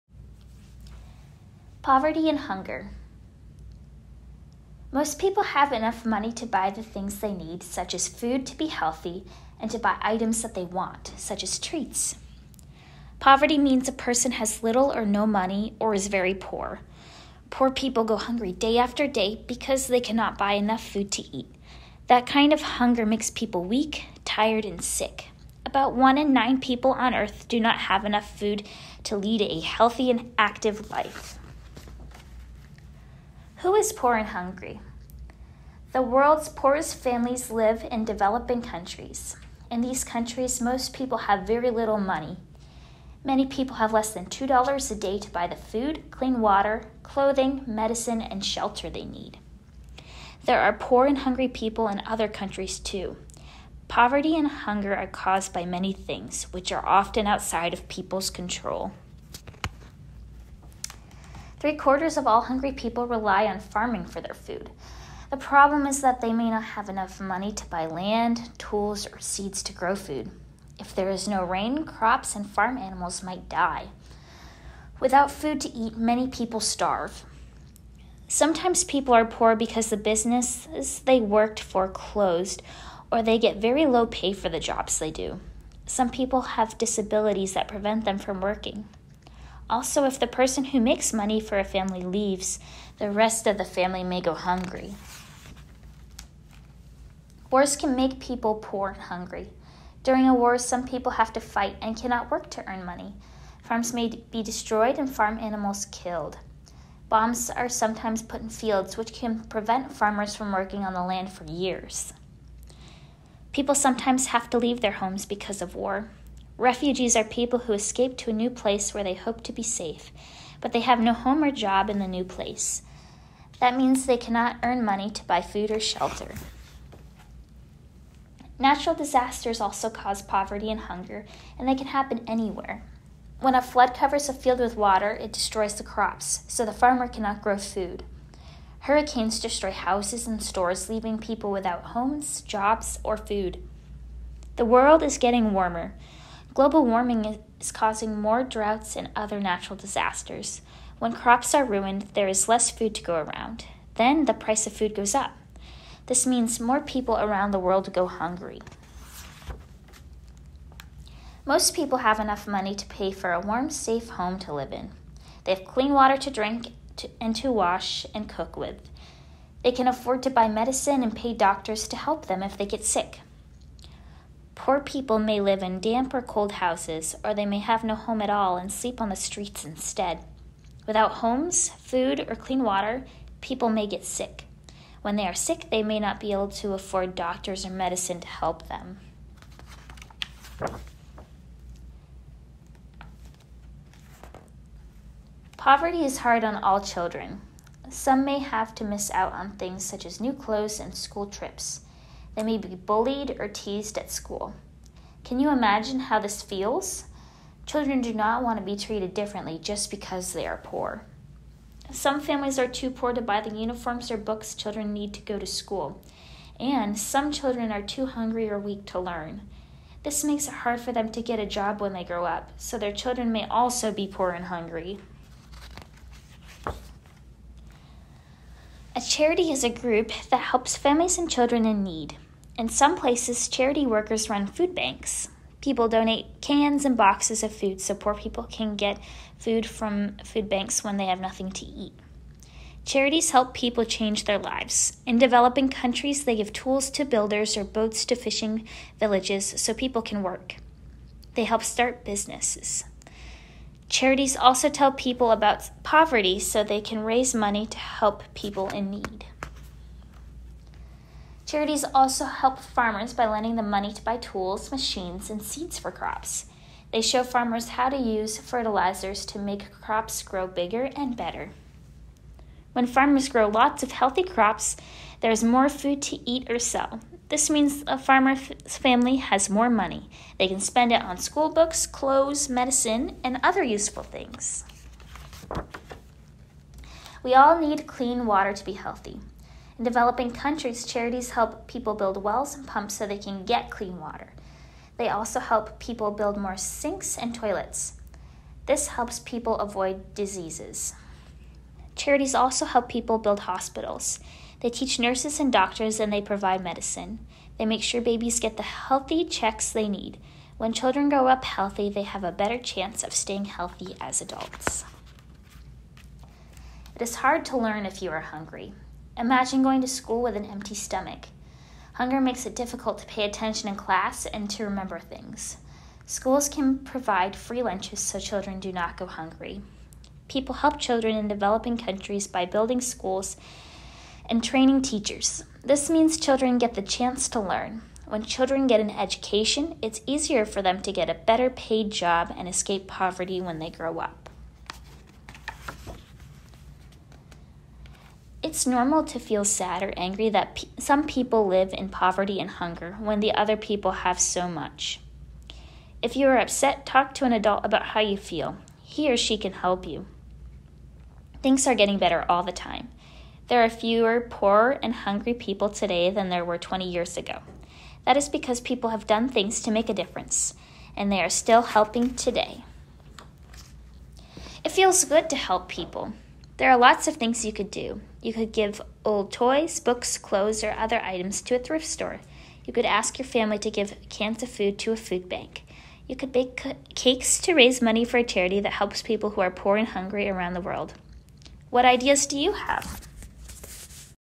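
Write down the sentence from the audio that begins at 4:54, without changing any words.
They also help people build more sinks and toilets.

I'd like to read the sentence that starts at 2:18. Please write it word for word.
Hurricanes destroy houses and stores, leaving people without homes, jobs, or food.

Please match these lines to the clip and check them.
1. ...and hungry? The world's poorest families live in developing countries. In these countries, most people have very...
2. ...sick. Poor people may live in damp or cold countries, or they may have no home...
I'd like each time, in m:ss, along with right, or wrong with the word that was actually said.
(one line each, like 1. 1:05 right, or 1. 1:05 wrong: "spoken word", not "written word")
1. 0:34 right
2. 2:52 wrong: "houses", not "countries".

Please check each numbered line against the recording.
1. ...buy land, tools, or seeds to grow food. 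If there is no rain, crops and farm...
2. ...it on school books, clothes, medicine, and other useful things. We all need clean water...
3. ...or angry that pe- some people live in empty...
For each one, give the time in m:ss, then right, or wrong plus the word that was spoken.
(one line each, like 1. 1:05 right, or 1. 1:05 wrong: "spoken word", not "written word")
1. 1:07 right
2. 4:40 right
3. 5:49 wrong: "poverty", not "empty".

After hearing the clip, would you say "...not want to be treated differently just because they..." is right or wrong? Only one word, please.
right.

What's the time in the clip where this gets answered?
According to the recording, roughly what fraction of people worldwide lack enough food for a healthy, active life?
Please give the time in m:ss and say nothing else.
0:25.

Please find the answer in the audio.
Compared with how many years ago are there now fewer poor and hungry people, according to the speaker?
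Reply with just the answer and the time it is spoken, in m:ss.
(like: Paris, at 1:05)
20 years, at 6:06.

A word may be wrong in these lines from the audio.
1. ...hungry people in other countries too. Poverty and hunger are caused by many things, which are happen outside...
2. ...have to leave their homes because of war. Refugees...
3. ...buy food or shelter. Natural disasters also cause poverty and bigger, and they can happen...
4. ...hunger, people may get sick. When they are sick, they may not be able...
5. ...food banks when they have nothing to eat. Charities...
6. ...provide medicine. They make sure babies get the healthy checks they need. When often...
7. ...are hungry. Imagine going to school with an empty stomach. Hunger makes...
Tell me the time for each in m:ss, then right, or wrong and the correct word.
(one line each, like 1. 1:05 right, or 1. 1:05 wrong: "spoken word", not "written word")
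1. 0:51 wrong: "often", not "happen"
2. 1:54 right
3. 2:05 wrong: "hunger", not "bigger"
4. 3:02 wrong: "water", not "hunger"
5. 4:00 right
6. 5:06 wrong: "children", not "often"
7. 5:18 right.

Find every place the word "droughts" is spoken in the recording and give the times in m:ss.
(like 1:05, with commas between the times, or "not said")
2:28.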